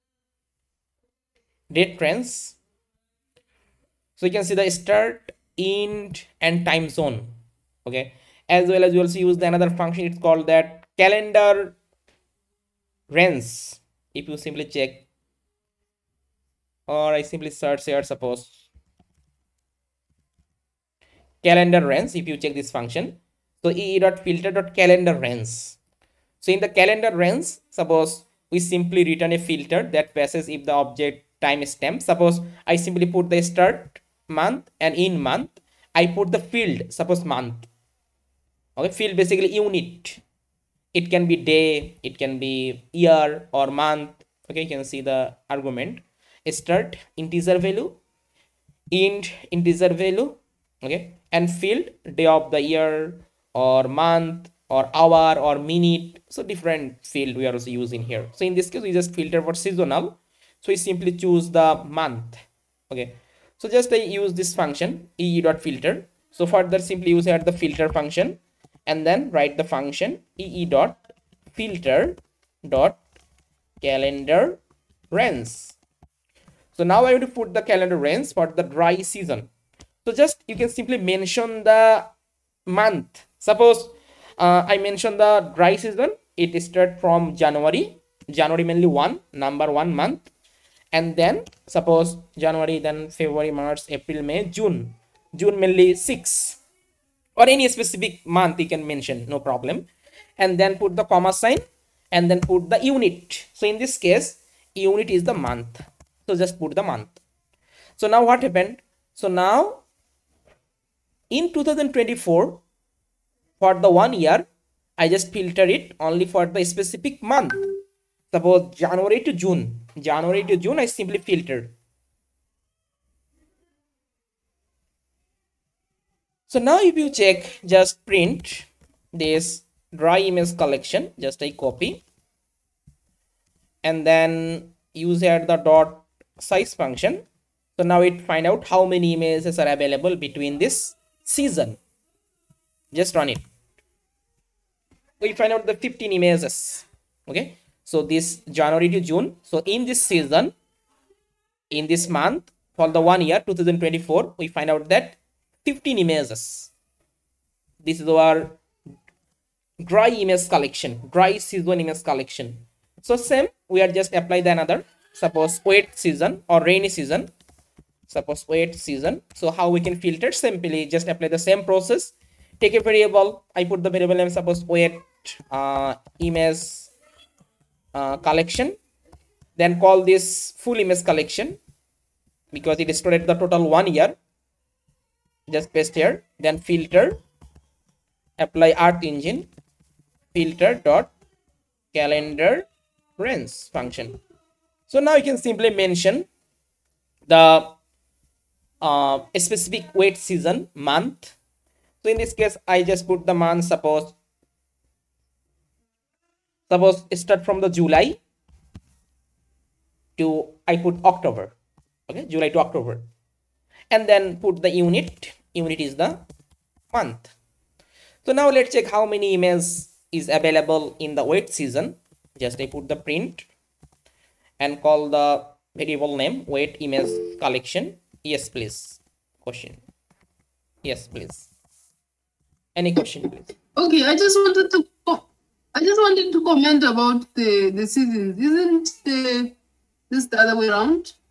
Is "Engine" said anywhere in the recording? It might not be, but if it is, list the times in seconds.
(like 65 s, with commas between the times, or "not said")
189 s.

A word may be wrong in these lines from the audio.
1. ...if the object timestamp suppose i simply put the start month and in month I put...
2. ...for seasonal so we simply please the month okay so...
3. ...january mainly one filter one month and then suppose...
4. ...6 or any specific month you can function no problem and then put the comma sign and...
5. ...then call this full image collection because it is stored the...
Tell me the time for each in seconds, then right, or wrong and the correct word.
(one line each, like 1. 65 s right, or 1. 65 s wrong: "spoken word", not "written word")
1. 30 s right
2. 59 s wrong: "choose", not "please"
3. 88 s wrong: "number", not "filter"
4. 95 s wrong: "mention", not "function"
5. 179 s right.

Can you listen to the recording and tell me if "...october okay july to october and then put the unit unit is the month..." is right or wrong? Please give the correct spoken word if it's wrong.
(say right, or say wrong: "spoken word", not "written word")
right.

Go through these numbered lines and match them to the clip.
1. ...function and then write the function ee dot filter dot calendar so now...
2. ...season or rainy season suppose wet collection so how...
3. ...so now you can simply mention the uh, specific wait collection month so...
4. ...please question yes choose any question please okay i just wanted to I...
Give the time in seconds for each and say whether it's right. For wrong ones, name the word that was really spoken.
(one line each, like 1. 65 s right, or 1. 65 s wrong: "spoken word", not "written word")
1. 67 s right
2. 165 s wrong: "season", not "collection"
3. 194 s wrong: "season", not "collection"
4. 228 s wrong: "please", not "choose".